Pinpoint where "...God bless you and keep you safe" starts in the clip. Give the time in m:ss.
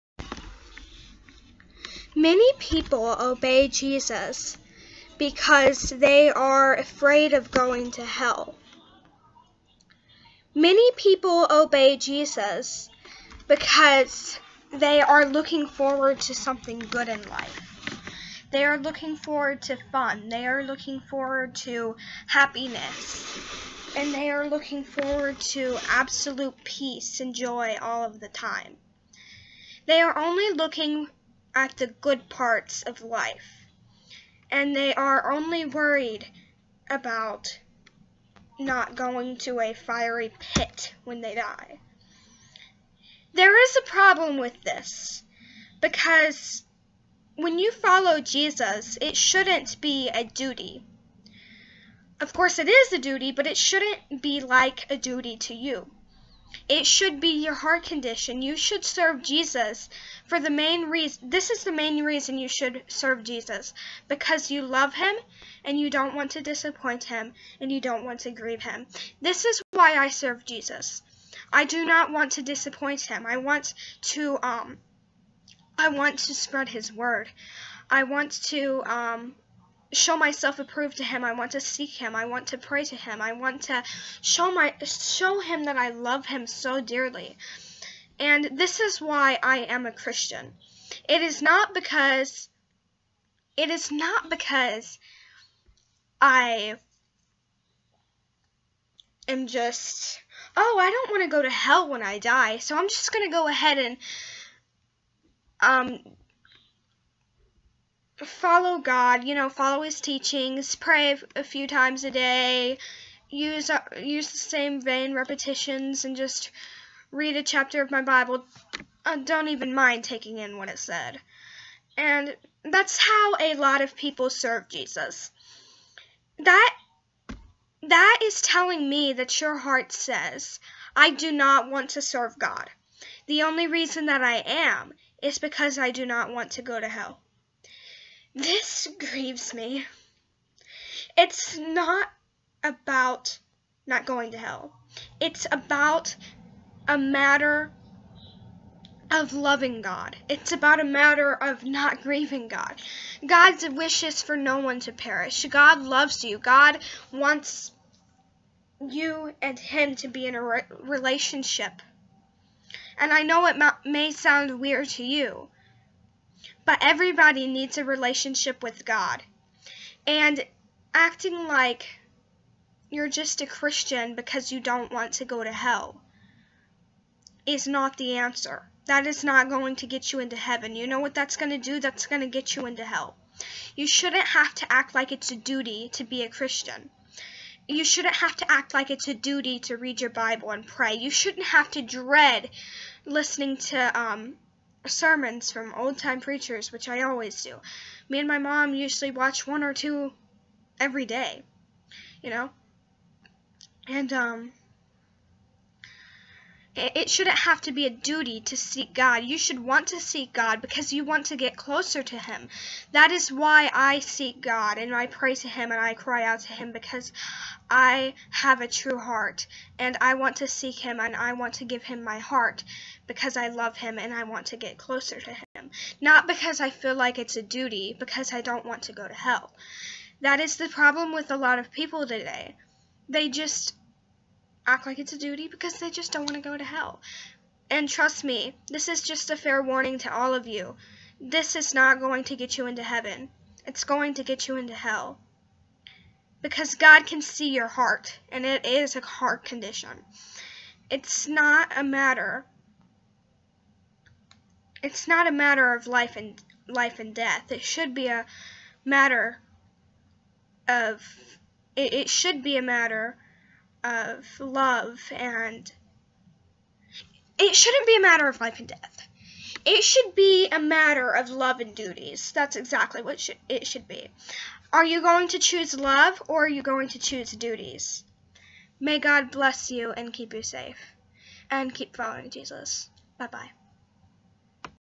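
4:38.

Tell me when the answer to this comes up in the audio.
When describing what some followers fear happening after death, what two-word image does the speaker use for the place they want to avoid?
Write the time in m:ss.
0:39.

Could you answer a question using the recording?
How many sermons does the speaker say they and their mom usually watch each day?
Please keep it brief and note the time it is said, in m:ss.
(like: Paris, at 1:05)
1 or 2, at 3:19.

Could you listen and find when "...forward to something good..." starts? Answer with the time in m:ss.
0:15.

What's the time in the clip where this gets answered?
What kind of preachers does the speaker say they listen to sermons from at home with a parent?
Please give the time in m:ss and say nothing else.
3:15.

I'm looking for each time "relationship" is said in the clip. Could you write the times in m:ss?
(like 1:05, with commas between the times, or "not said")
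2:40, 2:47.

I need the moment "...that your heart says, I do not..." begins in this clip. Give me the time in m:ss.
2:09.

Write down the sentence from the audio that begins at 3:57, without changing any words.
And trust me, this is just a fair warning to all of you.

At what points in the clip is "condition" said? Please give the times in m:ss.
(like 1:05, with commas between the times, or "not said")
0:57, 4:09.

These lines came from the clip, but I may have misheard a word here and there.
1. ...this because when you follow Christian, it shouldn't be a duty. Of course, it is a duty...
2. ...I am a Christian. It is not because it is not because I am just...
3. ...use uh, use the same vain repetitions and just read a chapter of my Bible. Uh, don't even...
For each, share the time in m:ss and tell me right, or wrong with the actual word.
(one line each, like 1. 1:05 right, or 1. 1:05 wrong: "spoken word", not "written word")
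1. 0:44 wrong: "Jesus", not "Christian"
2. 1:29 right
3. 1:53 right.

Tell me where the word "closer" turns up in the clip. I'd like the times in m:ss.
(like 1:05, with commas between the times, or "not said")
3:31, 3:44.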